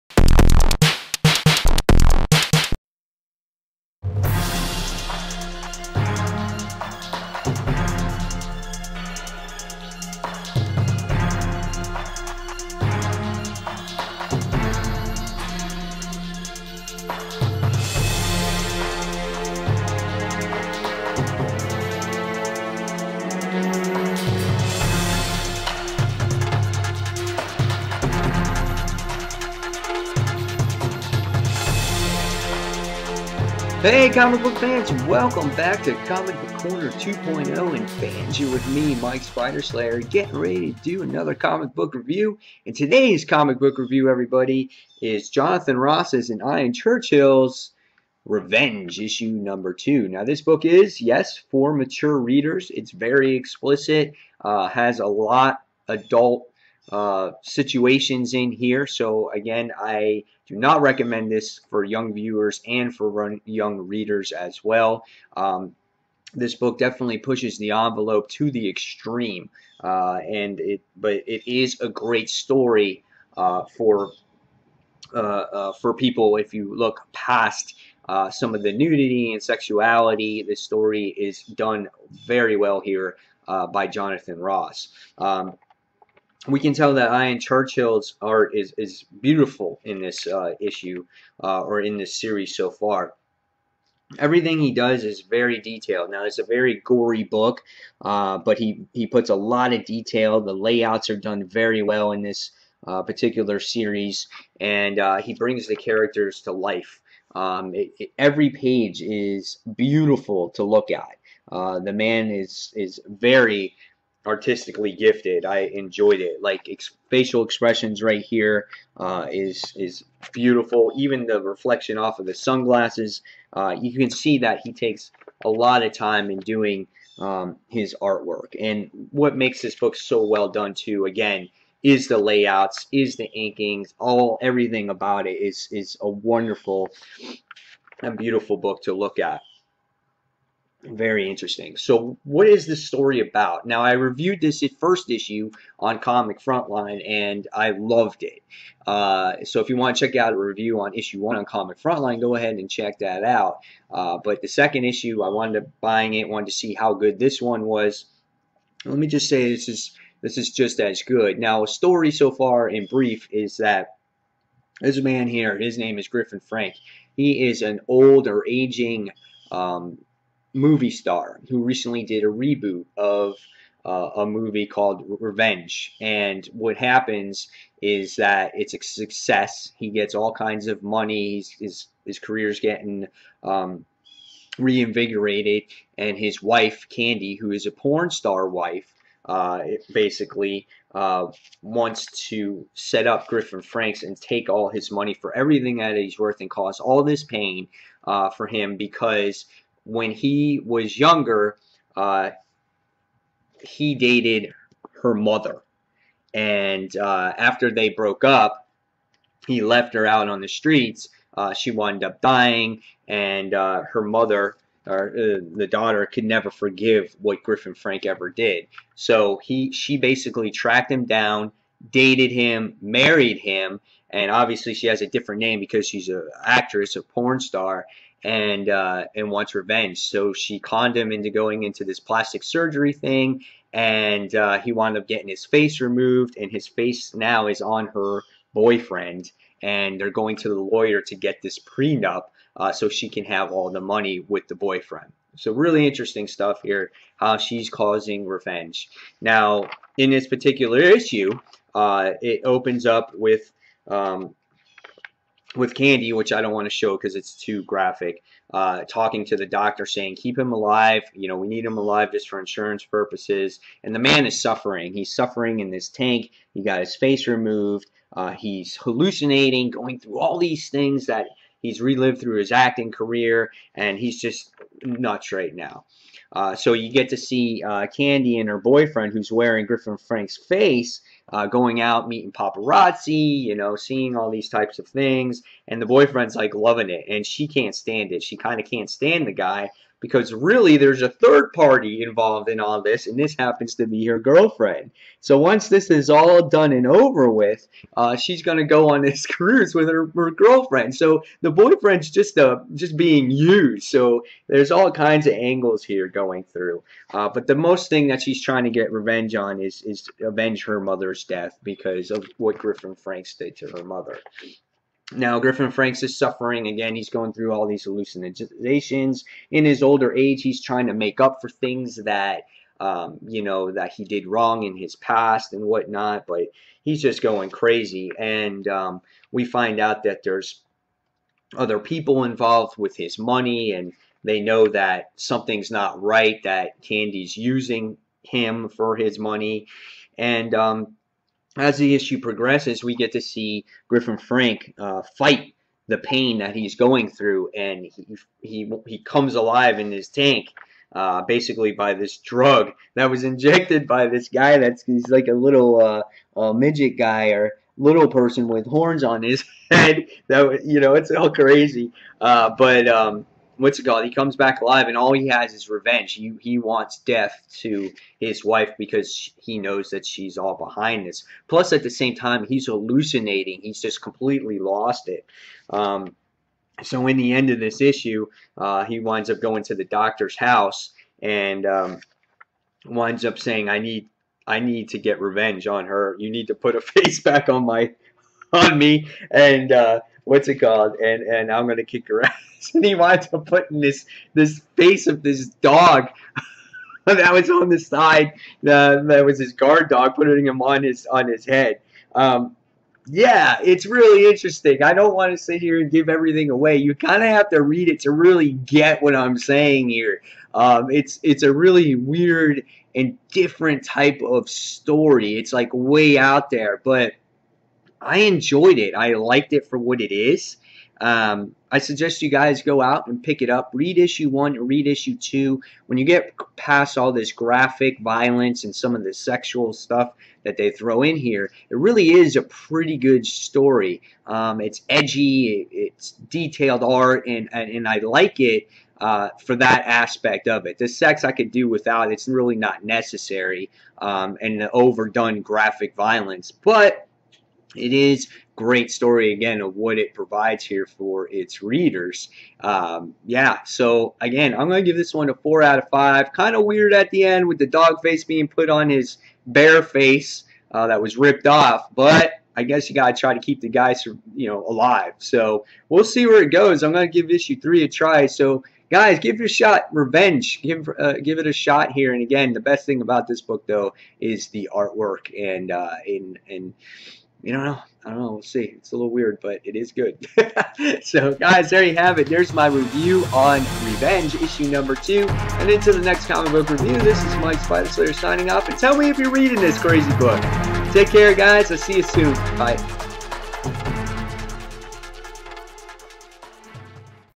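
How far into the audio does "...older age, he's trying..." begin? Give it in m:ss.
5:19.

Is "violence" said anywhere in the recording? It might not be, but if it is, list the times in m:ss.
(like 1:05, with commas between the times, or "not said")
7:08, 7:25.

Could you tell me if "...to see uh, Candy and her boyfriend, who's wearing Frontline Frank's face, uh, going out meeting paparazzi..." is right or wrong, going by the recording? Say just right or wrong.
wrong.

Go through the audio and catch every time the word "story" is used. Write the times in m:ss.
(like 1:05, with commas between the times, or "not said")
1:12, 1:20, 2:22, 2:41, 6:54, 7:13, 7:28.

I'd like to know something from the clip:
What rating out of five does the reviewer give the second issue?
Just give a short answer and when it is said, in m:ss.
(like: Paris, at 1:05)
4, at 7:35.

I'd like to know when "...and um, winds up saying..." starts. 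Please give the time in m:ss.
6:21.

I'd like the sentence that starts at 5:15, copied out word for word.
Now, Griffin Franks is suffering again.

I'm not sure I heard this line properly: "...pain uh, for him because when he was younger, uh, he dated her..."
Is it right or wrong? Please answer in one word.
right.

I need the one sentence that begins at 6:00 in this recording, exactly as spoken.
That you know, it's all crazy.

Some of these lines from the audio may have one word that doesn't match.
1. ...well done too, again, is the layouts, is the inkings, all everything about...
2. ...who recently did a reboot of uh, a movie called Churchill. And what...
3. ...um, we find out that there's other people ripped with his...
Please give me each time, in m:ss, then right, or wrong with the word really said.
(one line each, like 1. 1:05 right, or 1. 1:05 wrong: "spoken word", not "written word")
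1. 2:10 right
2. 2:51 wrong: "Revenge", not "Churchill"
3. 5:28 wrong: "involved", not "ripped".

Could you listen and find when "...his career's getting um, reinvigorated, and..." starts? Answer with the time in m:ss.
3:02.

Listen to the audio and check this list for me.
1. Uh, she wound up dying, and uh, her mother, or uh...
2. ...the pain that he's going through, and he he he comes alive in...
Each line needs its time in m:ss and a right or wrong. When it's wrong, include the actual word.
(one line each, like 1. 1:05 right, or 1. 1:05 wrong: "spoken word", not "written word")
1. 3:31 right
2. 5:45 right.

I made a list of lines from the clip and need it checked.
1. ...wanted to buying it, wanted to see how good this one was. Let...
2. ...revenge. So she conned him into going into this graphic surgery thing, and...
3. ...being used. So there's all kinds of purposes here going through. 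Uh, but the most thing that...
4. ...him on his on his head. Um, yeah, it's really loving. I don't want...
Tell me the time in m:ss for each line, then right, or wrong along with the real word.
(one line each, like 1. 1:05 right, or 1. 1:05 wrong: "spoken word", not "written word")
1. 2:35 right
2. 3:49 wrong: "plastic", not "graphic"
3. 5:02 wrong: "angles", not "purposes"
4. 6:40 wrong: "interesting", not "loving".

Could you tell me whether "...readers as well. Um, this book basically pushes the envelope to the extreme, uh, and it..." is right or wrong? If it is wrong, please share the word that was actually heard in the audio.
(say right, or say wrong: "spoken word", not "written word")
wrong: "definitely", not "basically".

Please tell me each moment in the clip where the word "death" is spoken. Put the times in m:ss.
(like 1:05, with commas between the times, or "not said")
5:11, 6:06.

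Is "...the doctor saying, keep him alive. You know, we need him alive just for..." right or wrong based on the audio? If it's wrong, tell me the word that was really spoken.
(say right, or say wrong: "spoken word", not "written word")
right.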